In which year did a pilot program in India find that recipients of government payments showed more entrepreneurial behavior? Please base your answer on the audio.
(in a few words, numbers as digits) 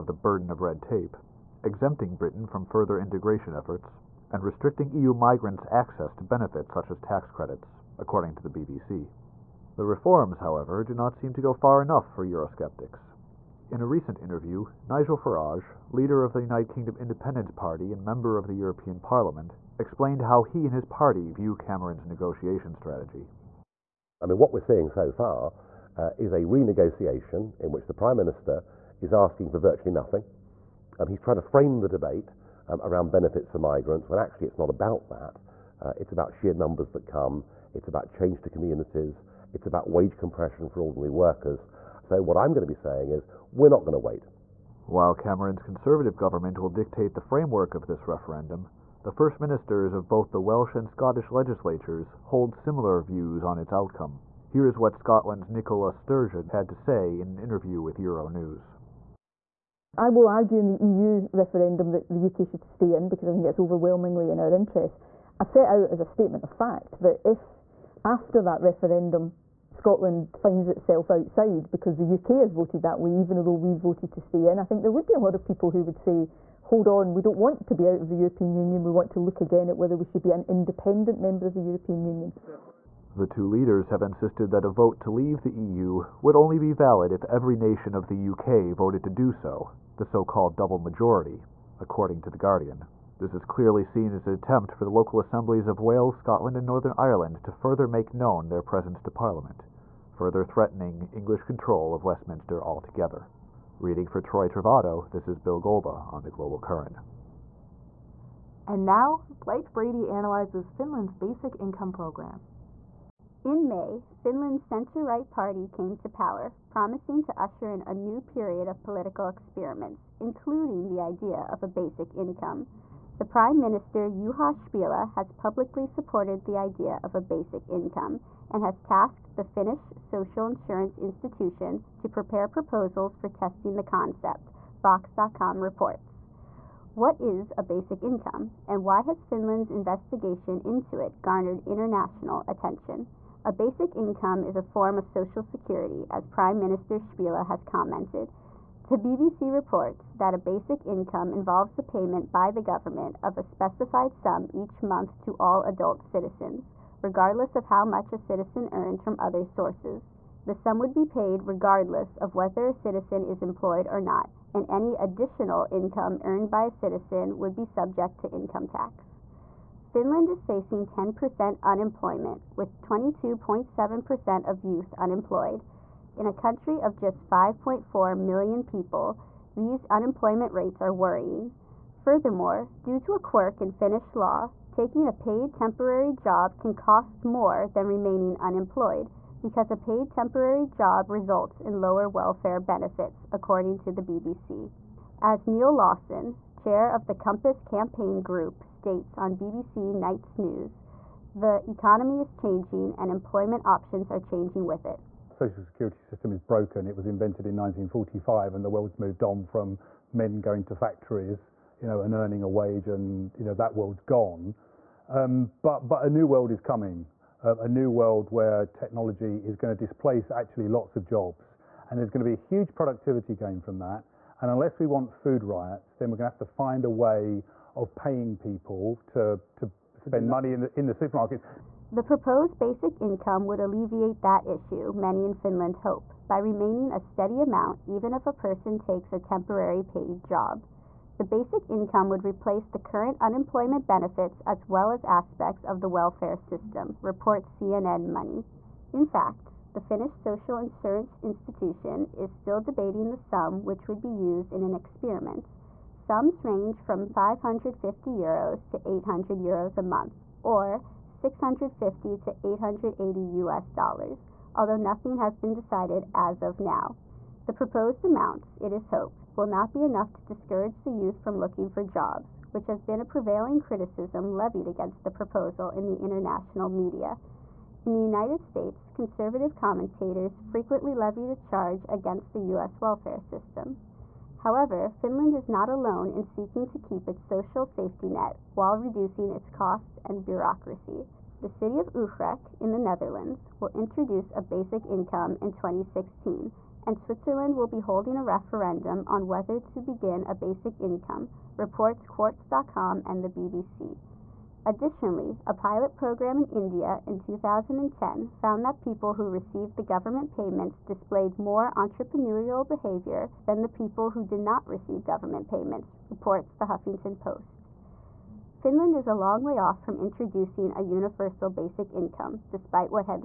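2010.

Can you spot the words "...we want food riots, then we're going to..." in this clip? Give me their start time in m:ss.
3:44.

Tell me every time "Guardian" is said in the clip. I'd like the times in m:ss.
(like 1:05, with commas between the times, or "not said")
1:32.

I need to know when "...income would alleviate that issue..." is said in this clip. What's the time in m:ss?
3:53.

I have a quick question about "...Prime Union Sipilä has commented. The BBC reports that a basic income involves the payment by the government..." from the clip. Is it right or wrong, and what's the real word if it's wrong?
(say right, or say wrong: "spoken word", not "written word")
wrong: "Minister", not "Union".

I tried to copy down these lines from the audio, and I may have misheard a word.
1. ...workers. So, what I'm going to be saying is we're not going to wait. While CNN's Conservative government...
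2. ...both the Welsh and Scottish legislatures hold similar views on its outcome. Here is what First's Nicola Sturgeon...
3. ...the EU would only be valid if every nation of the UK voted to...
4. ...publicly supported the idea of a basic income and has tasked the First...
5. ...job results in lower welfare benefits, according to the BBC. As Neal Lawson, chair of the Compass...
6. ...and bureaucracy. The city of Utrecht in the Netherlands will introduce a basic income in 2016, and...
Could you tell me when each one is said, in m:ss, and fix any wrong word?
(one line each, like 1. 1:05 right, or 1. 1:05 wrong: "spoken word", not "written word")
1. 0:41 wrong: "Cameron", not "CNN"
2. 0:50 wrong: "Scotland", not "First"
3. 1:25 right
4. 2:05 wrong: "Finnish", not "First"
5. 3:10 right
6. 4:50 right.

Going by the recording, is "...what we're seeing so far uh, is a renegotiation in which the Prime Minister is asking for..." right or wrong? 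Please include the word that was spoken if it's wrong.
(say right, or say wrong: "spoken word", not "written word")
right.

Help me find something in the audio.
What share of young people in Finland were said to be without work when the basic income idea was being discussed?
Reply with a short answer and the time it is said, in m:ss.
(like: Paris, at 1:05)
22.7%, at 2:52.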